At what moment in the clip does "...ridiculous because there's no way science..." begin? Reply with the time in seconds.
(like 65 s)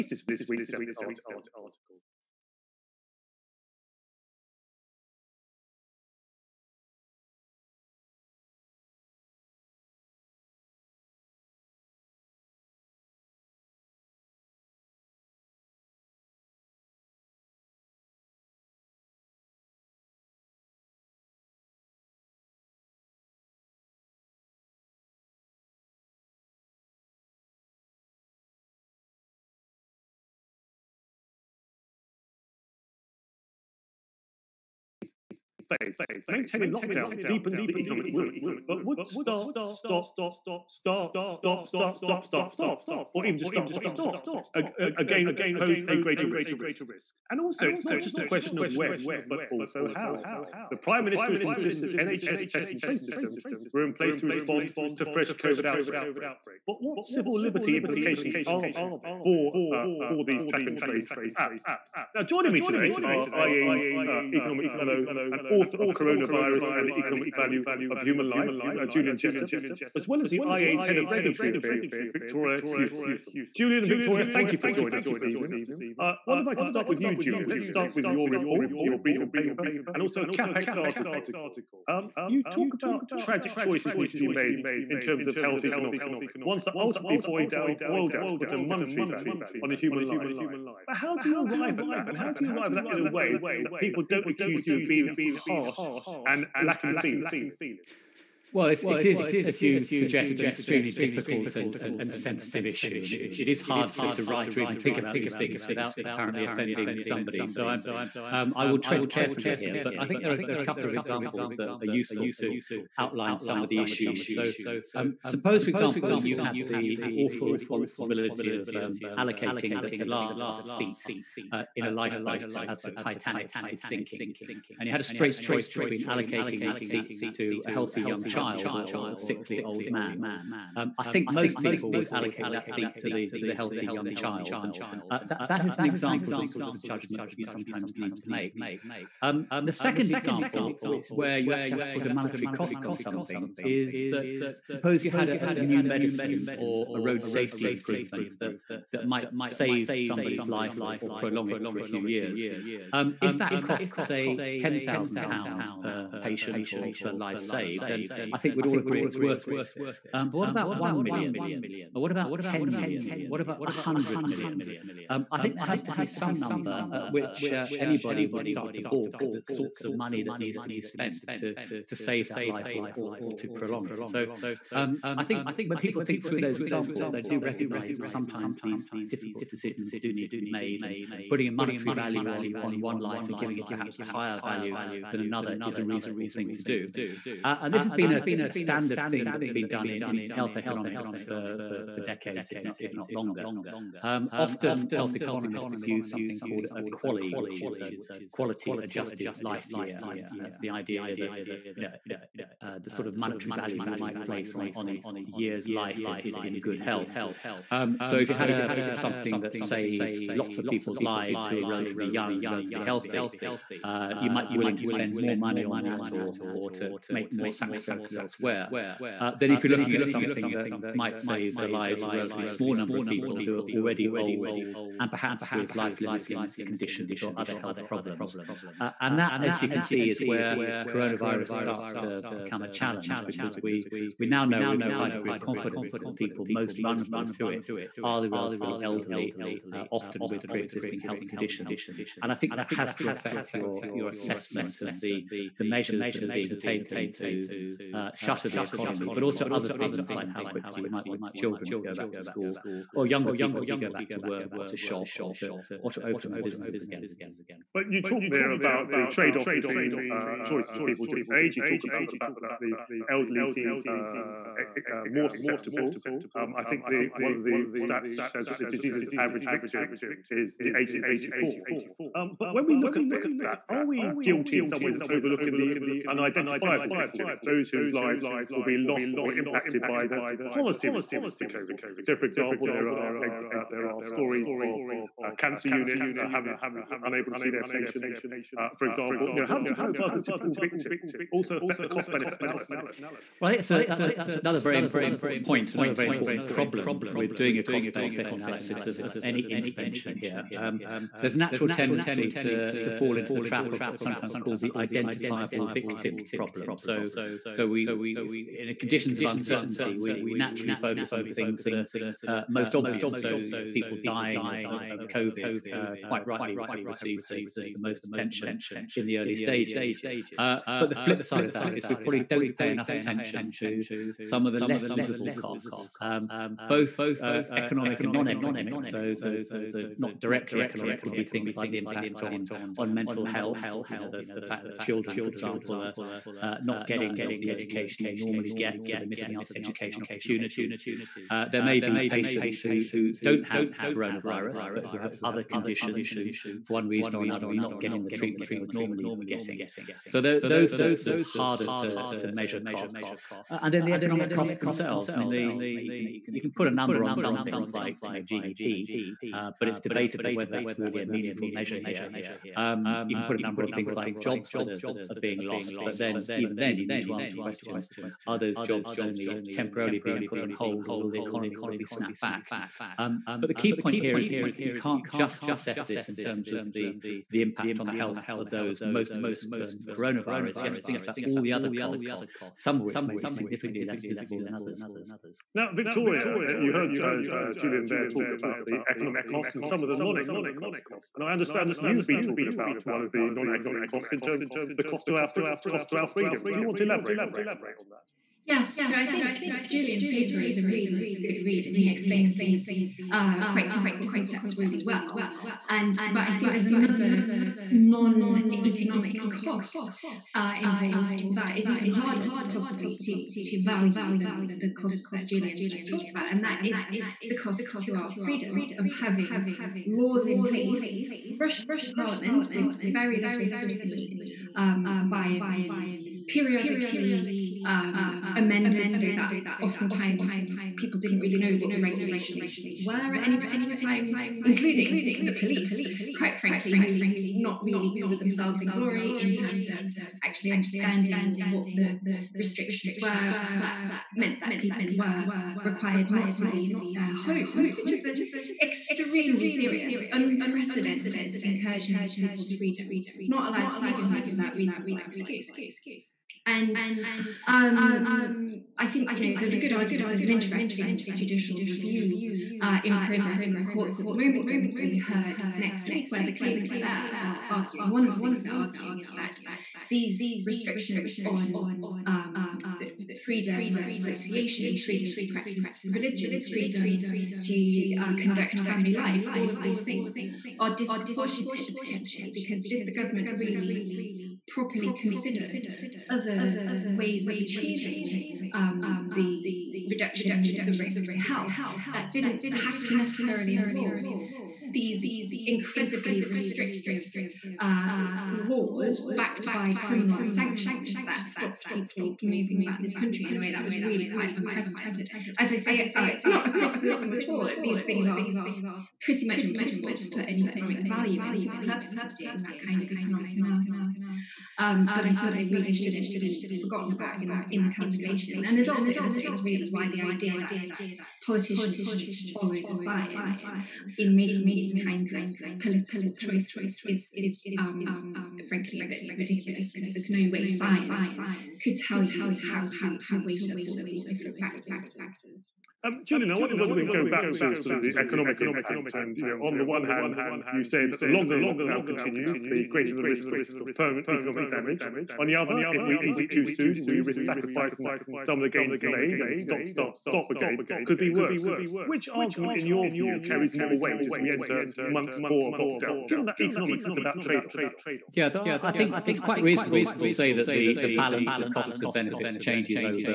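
529 s.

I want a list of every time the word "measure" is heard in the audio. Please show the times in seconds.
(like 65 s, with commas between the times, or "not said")
245 s, 352 s, 361 s.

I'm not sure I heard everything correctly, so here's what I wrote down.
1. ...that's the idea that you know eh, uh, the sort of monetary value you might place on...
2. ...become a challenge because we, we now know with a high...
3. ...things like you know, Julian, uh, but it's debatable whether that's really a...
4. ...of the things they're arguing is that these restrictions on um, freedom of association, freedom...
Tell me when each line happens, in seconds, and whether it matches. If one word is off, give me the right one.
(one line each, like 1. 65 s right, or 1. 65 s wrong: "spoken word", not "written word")
1. 200 s right
2. 232 s right
3. 357 s wrong: "GDP", not "Julian"
4. 468 s right.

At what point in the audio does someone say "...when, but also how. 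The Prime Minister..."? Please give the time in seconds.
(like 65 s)
48 s.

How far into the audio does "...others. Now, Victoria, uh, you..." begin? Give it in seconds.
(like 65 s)
384 s.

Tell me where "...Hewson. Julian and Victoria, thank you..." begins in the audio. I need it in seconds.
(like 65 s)
72 s.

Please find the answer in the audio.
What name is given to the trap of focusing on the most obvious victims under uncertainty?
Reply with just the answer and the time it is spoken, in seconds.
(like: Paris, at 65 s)
Identifiable victim problem, at 304 s.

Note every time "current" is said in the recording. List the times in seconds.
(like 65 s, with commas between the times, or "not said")
not said.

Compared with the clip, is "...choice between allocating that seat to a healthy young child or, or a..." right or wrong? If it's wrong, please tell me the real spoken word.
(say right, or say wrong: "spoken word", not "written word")
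right.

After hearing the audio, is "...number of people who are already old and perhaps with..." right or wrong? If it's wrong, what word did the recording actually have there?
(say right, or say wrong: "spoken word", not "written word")
right.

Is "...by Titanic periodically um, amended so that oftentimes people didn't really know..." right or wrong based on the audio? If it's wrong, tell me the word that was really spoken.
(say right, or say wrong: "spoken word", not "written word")
wrong: "MPs", not "Titanic".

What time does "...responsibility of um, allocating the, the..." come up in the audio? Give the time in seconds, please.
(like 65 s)
117 s.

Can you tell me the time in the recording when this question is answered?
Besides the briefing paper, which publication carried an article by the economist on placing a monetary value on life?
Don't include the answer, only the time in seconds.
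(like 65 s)
80 s.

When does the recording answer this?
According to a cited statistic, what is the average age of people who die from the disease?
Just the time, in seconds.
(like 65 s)
271 s.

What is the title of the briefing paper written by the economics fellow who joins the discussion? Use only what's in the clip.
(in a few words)
Coronavirus and the Economic Value of Human Life.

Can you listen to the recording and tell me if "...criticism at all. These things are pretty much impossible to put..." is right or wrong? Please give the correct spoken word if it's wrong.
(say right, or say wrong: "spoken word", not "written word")
right.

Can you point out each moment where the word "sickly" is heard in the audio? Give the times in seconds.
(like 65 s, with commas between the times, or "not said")
129 s.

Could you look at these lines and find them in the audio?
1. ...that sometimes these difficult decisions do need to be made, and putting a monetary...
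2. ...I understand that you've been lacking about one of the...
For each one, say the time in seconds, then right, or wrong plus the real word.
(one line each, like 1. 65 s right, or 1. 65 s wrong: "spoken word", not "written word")
1. 177 s right
2. 391 s wrong: "talking", not "lacking".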